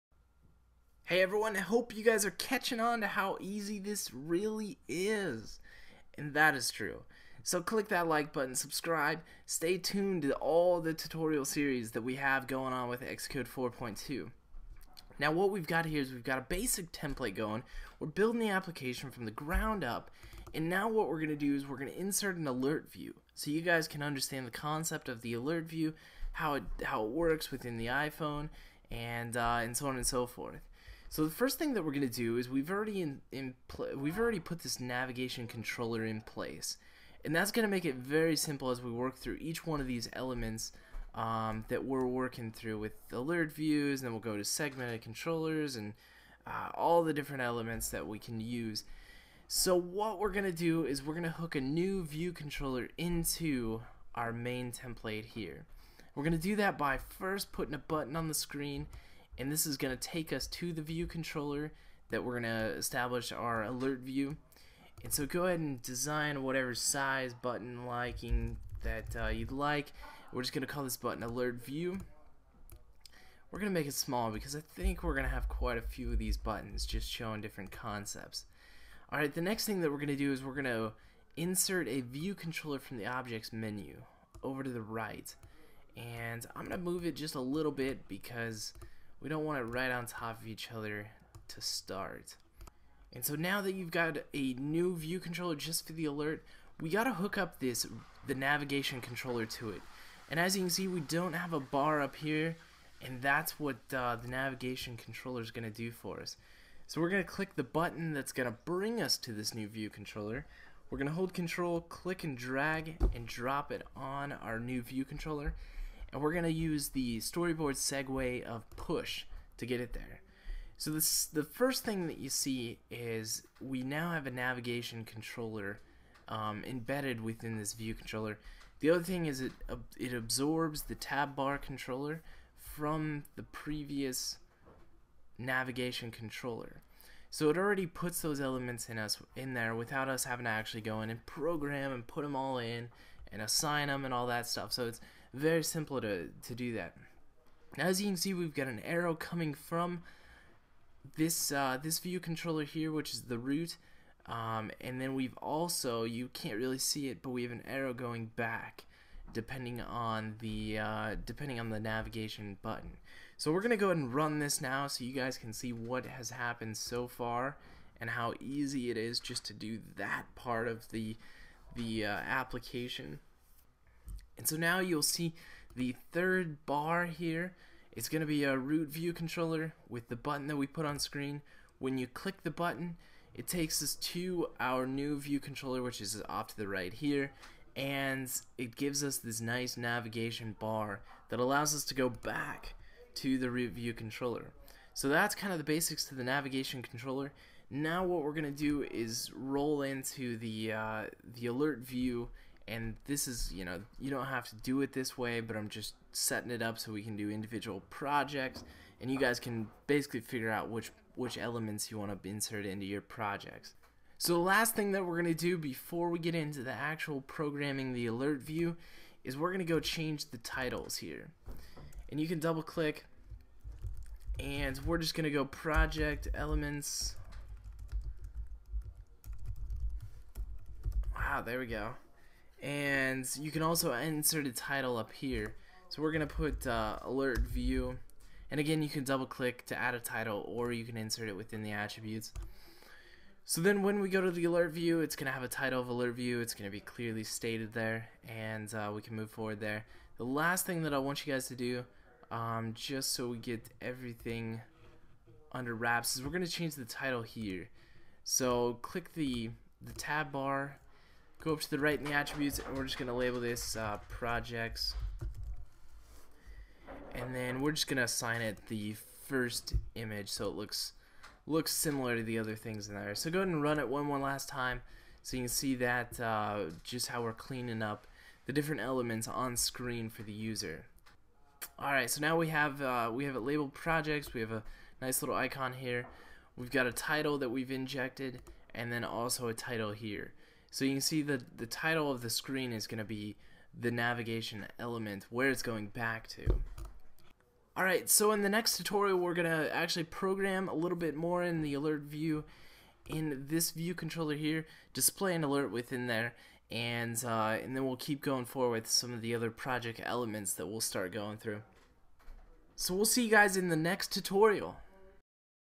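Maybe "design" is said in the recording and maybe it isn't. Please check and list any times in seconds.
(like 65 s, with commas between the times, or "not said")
65 s.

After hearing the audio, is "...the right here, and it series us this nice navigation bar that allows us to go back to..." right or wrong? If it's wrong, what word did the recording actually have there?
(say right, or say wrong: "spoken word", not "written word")
wrong: "gives", not "series".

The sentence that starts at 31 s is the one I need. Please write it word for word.
So the first thing that we're going to do is we've already in, in we've already put this navigation controller in place.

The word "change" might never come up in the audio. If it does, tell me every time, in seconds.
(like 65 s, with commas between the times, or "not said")
219 s, 256 s.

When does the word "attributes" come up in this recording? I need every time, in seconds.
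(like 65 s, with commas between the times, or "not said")
241 s, 262 s.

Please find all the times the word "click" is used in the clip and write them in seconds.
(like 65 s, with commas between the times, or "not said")
7 s, 107 s, 111 s, 182 s, 222 s, 239 s, 258 s.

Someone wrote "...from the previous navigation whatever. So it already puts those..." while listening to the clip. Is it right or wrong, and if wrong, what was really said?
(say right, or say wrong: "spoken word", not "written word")
wrong: "controller", not "whatever".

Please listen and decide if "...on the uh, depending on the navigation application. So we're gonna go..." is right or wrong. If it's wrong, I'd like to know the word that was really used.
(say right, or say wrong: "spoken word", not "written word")
wrong: "button", not "application".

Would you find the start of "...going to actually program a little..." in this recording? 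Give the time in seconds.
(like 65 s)
299 s.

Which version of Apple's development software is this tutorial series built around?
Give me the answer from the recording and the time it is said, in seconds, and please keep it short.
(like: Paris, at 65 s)
Xcode 4.2, at 13 s.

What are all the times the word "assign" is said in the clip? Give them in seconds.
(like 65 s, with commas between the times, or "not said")
143 s, 268 s.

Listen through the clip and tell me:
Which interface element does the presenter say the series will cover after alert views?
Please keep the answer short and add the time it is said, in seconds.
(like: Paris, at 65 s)
segmented controllers, at 44 s.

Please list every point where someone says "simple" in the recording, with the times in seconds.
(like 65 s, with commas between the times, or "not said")
38 s, 145 s.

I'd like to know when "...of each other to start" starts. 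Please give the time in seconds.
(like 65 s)
90 s.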